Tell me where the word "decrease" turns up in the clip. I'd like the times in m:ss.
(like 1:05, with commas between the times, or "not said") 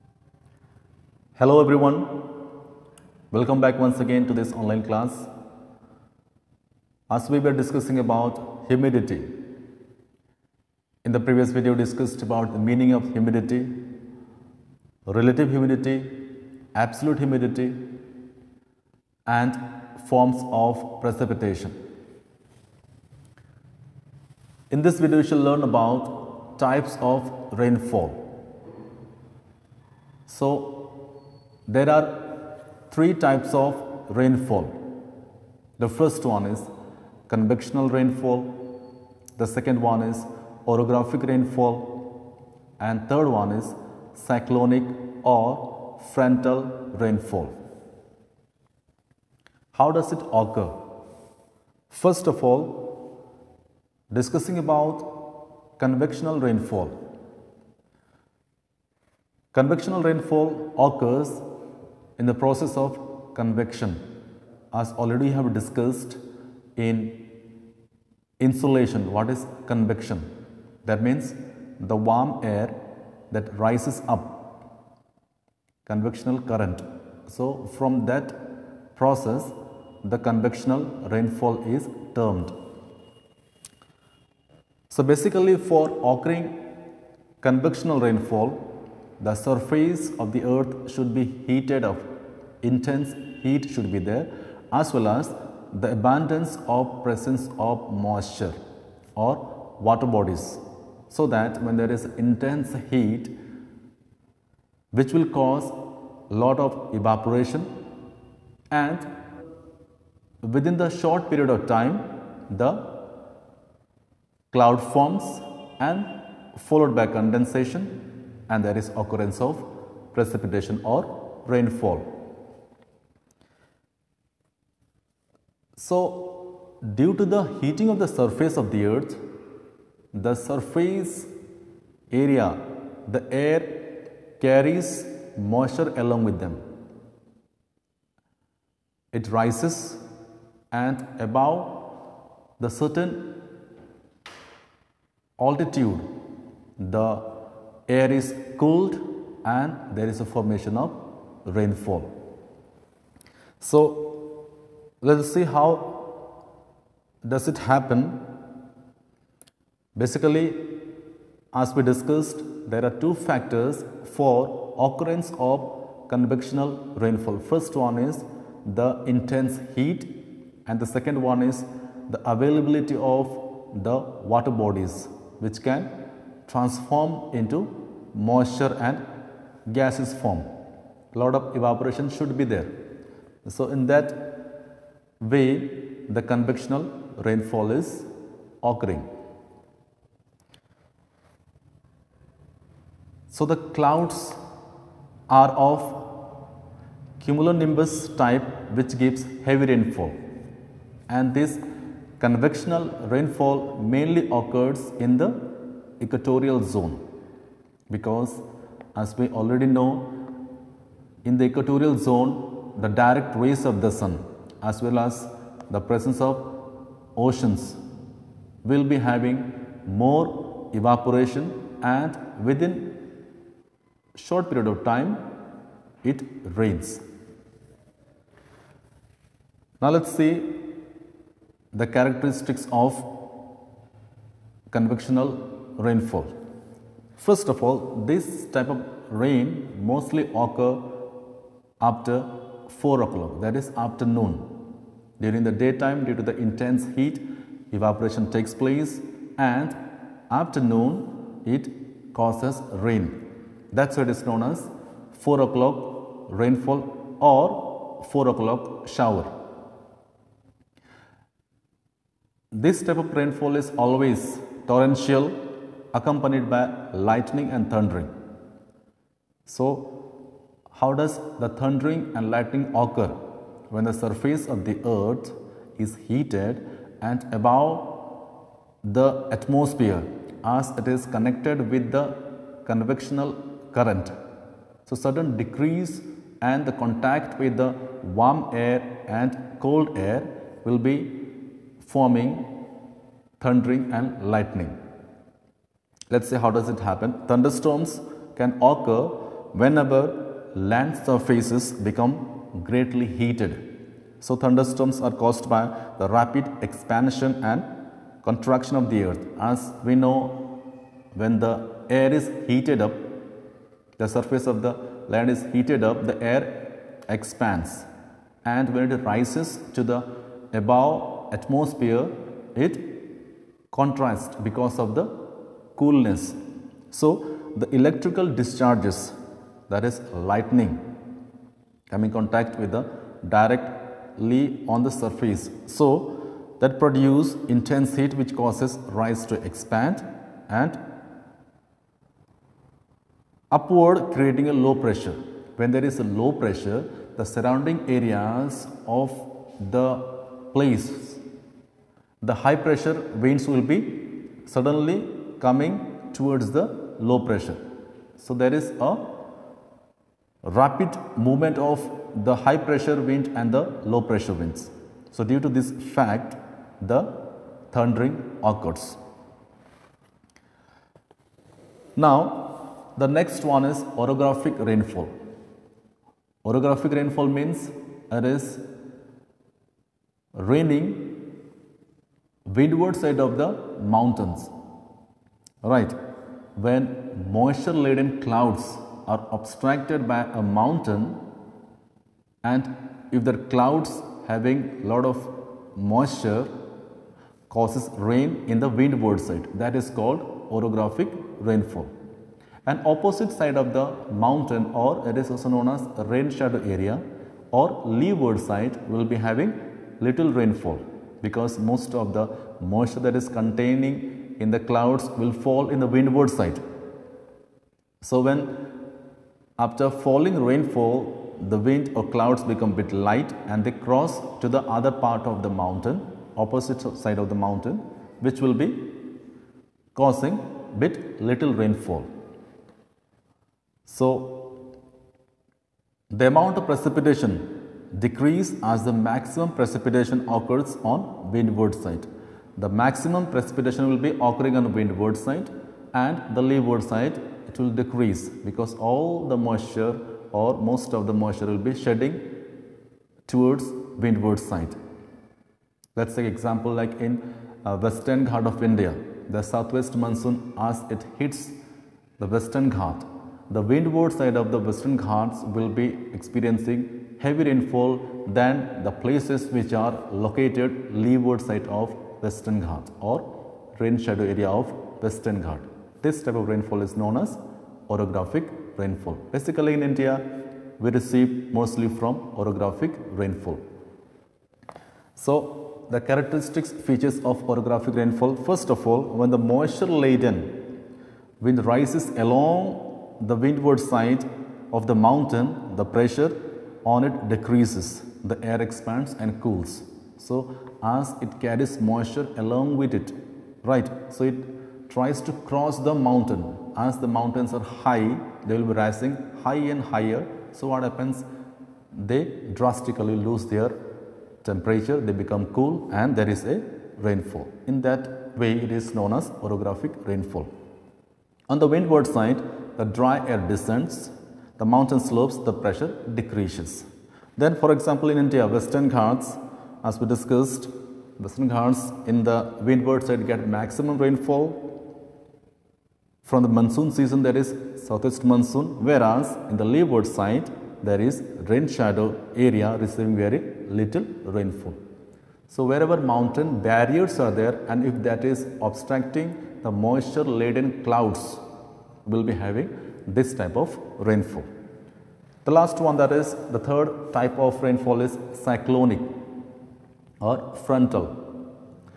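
4:45, 7:18, 7:27, 8:17, 8:46.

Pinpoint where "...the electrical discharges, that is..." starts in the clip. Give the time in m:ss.
5:27.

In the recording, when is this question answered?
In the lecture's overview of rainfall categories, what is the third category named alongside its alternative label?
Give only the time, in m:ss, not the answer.
0:44.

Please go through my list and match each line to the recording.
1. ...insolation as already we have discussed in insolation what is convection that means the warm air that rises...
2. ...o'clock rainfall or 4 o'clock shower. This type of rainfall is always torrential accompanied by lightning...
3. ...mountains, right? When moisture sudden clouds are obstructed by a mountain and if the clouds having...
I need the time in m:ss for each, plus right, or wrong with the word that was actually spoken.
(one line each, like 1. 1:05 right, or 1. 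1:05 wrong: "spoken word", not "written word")
1. 1:03 wrong: "convection", not "insolation"
2. 4:15 right
3. 6:23 wrong: "laden", not "sudden".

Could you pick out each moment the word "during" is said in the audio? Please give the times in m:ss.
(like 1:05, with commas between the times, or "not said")
4:05.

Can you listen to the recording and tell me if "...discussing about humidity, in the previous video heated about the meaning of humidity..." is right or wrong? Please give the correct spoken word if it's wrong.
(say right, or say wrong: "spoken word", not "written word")
wrong: "discussed", not "heated".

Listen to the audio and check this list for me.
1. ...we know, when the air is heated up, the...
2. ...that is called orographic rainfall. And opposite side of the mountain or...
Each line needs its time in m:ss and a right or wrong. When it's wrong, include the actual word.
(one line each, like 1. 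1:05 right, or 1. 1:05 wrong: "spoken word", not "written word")
1. 5:09 right
2. 6:39 right.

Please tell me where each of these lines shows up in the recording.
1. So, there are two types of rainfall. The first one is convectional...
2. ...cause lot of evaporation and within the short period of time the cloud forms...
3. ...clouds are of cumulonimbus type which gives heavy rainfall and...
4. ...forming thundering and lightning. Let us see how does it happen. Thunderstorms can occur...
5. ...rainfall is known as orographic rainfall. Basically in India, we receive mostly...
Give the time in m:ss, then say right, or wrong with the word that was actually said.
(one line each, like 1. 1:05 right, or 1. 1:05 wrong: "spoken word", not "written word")
1. 0:30 wrong: "three", not "two"
2. 1:45 right
3. 3:13 right
4. 4:51 right
5. 7:56 right.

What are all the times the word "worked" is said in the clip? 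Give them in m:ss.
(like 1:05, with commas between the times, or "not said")
not said.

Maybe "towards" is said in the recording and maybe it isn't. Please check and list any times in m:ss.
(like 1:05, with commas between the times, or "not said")
5:56, 7:33.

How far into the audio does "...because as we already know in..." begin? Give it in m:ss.
3:27.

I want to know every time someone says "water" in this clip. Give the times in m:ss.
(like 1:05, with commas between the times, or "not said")
1:39, 2:54.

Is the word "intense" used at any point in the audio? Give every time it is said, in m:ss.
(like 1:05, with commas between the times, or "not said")
1:32, 1:42, 2:49, 4:06, 5:37.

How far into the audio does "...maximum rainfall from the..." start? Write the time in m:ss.
8:53.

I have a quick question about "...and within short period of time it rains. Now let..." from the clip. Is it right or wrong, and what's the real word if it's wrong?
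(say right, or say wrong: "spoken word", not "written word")
right.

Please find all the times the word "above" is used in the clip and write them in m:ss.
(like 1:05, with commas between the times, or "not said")
2:21, 4:37, 5:20.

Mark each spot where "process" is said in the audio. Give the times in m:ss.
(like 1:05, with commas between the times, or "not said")
1:02, 1:19.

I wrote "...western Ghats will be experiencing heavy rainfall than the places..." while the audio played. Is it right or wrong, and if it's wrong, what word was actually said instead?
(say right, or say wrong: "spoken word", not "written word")
right.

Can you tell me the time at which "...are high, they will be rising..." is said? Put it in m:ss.
8:27.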